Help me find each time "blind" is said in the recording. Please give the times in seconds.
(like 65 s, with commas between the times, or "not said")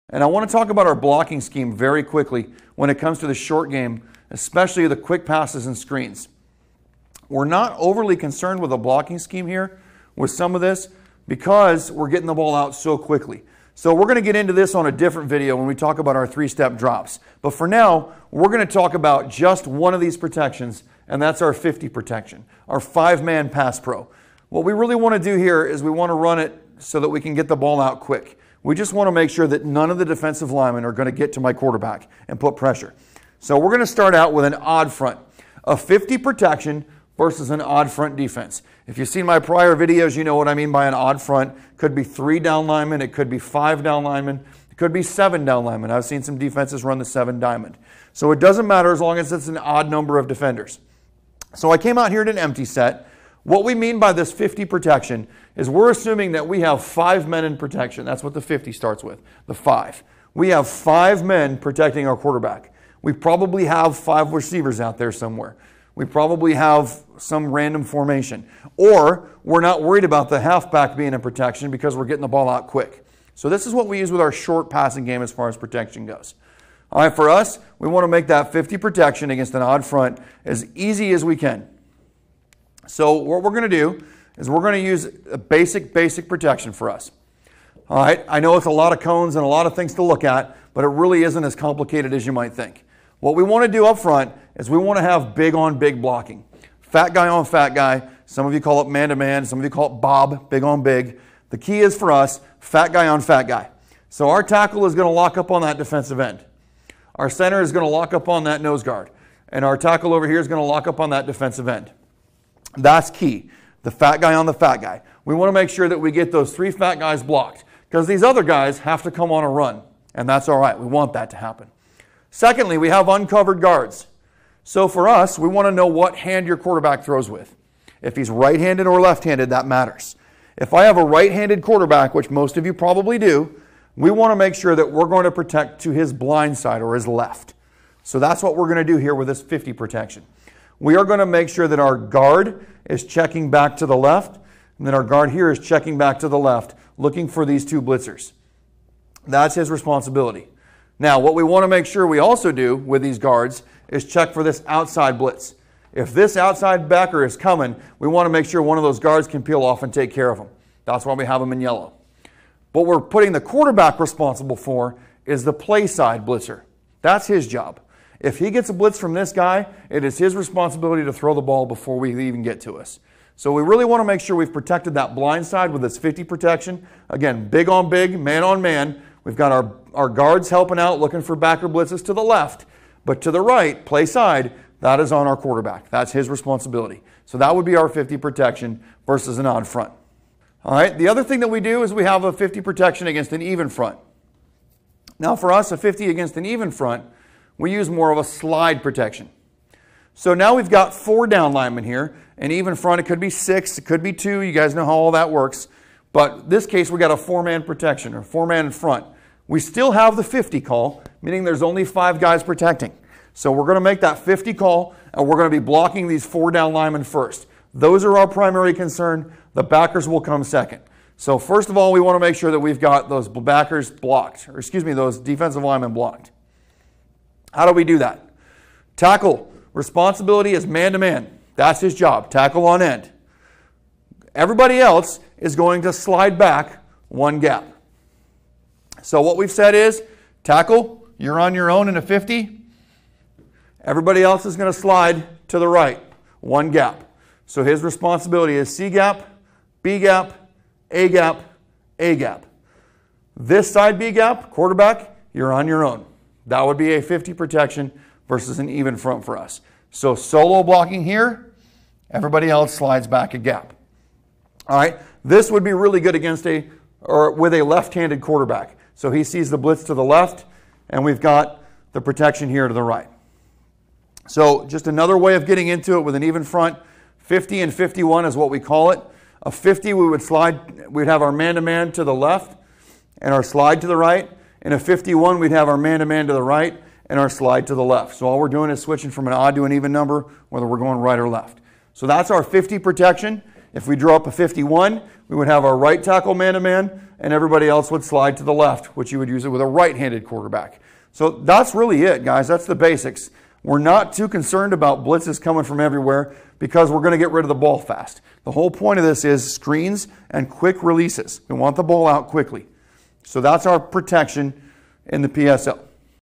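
136 s, 175 s.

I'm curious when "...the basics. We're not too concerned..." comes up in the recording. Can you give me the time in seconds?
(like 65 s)
302 s.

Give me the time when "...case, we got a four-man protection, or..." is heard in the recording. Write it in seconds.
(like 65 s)
206 s.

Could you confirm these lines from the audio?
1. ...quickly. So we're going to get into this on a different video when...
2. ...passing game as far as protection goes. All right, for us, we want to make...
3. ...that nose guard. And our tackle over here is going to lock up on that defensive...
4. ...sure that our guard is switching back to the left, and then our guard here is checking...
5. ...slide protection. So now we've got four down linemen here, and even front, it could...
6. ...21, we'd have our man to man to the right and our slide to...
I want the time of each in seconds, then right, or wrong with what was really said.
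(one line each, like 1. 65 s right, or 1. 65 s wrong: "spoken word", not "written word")
1. 12 s right
2. 74 s right
3. 108 s right
4. 141 s wrong: "checking", not "switching"
5. 198 s right
6. 284 s wrong: "51", not "21".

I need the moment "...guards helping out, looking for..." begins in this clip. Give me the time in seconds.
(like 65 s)
180 s.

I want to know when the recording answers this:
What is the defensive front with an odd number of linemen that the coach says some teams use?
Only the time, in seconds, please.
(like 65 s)
47 s.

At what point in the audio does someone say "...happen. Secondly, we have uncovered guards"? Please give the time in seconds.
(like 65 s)
121 s.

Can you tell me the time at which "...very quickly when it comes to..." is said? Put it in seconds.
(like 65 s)
1 s.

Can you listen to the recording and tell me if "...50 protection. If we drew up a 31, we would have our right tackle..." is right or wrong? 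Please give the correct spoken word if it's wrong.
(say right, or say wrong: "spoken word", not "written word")
wrong: "51", not "31".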